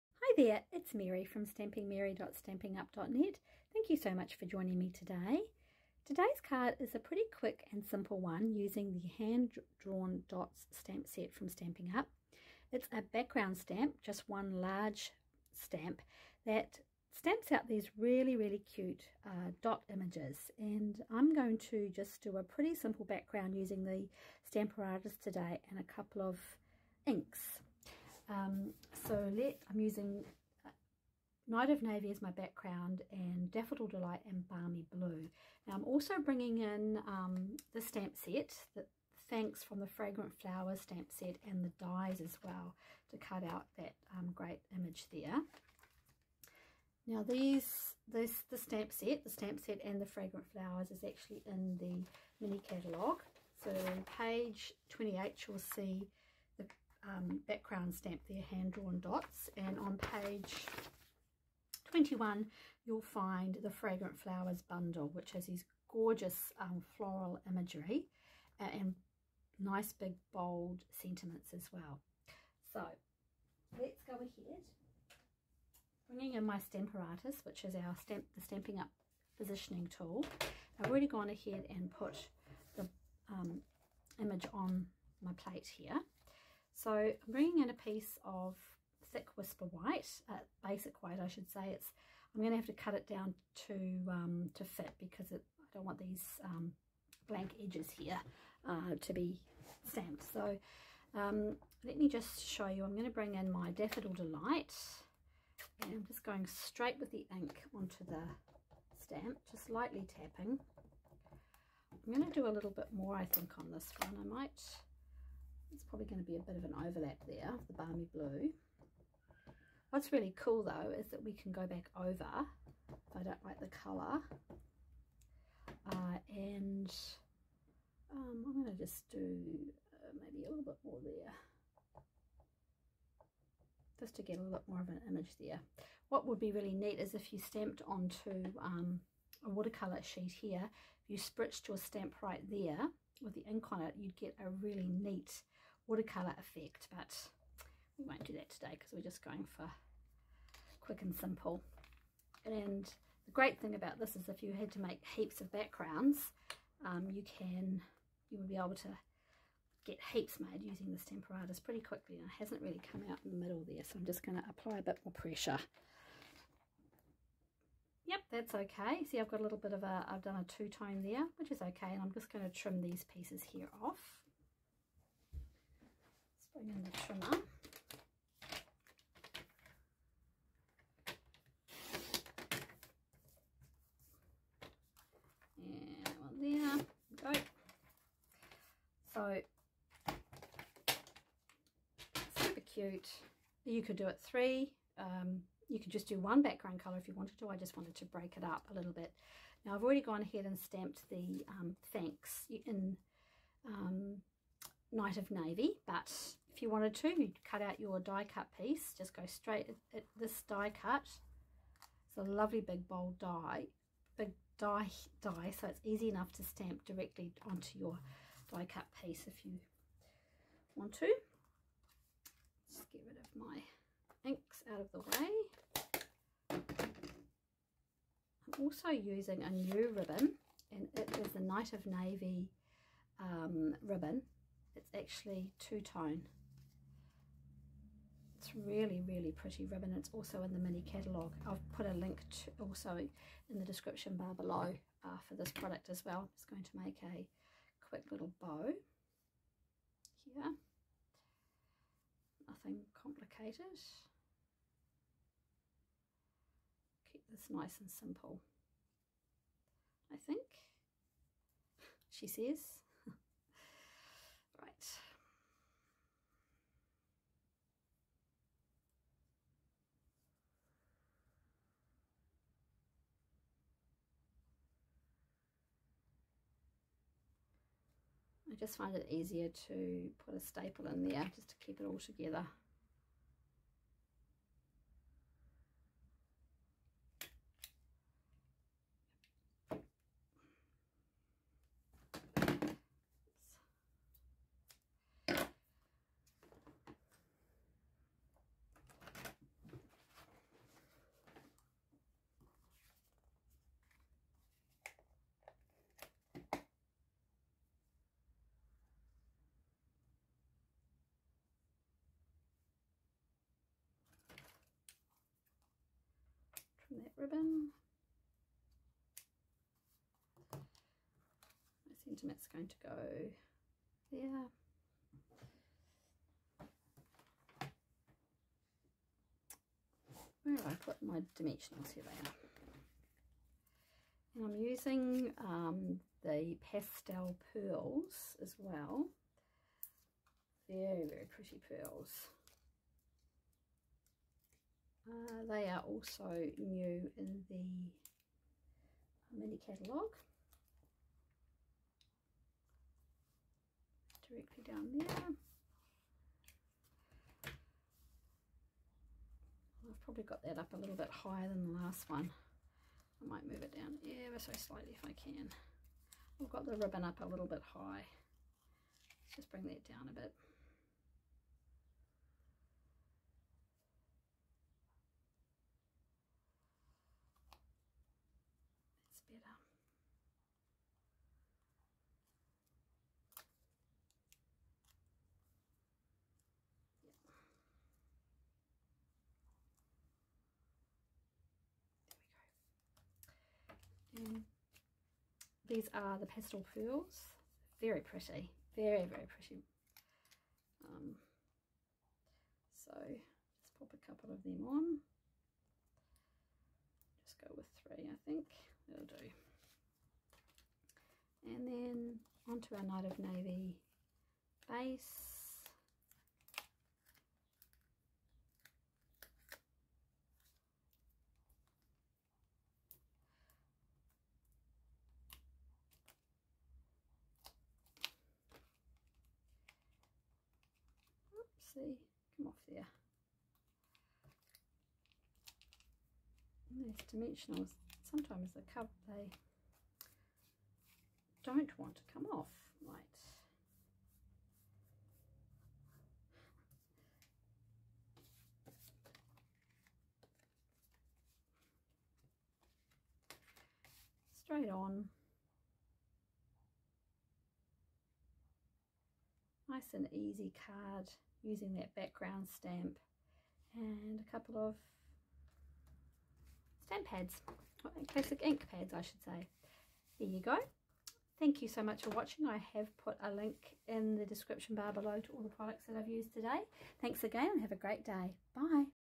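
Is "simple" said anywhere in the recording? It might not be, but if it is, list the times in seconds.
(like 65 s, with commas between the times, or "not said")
7 s, 22 s, 151 s, 257 s.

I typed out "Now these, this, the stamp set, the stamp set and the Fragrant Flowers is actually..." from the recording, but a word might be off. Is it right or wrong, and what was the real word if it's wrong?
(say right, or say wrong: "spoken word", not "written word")
right.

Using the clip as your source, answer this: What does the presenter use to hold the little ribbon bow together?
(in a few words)
staple.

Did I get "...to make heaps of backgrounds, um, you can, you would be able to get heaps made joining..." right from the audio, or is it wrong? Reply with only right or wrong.
wrong.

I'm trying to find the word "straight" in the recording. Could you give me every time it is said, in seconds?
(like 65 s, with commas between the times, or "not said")
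106 s, 209 s, 454 s.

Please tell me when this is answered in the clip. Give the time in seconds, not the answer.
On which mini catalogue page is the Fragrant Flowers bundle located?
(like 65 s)
61 s.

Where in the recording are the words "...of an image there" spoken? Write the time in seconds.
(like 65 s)
134 s.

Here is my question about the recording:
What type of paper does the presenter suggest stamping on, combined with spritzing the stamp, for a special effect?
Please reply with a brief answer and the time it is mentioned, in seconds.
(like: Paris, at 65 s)
watercolour sheet, at 139 s.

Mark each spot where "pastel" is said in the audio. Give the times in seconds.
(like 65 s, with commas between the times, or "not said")
336 s, 396 s.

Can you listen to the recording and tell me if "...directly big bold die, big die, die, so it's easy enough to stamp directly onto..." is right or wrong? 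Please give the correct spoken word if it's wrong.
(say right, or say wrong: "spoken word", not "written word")
wrong: "lovely", not "directly".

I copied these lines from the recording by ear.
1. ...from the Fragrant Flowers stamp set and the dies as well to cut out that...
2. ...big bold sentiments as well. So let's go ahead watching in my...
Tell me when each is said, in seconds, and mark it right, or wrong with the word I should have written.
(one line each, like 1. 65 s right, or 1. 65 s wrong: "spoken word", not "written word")
1. 39 s right
2. 69 s wrong: "bringing", not "watching".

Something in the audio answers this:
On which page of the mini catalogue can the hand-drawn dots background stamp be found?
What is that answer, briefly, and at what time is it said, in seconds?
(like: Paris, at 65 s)
28, at 54 s.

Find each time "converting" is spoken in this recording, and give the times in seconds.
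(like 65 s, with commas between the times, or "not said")
not said.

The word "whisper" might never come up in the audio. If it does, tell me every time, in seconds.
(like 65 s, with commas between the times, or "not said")
89 s.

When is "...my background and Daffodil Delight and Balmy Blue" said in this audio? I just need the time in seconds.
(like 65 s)
32 s.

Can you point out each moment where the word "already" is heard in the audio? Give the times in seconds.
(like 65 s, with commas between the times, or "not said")
80 s, 199 s.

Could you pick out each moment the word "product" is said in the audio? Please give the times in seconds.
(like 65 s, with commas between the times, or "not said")
245 s, 475 s.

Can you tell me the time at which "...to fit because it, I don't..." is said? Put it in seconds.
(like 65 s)
94 s.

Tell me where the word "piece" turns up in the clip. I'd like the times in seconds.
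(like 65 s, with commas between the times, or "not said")
87 s, 173 s, 208 s, 219 s.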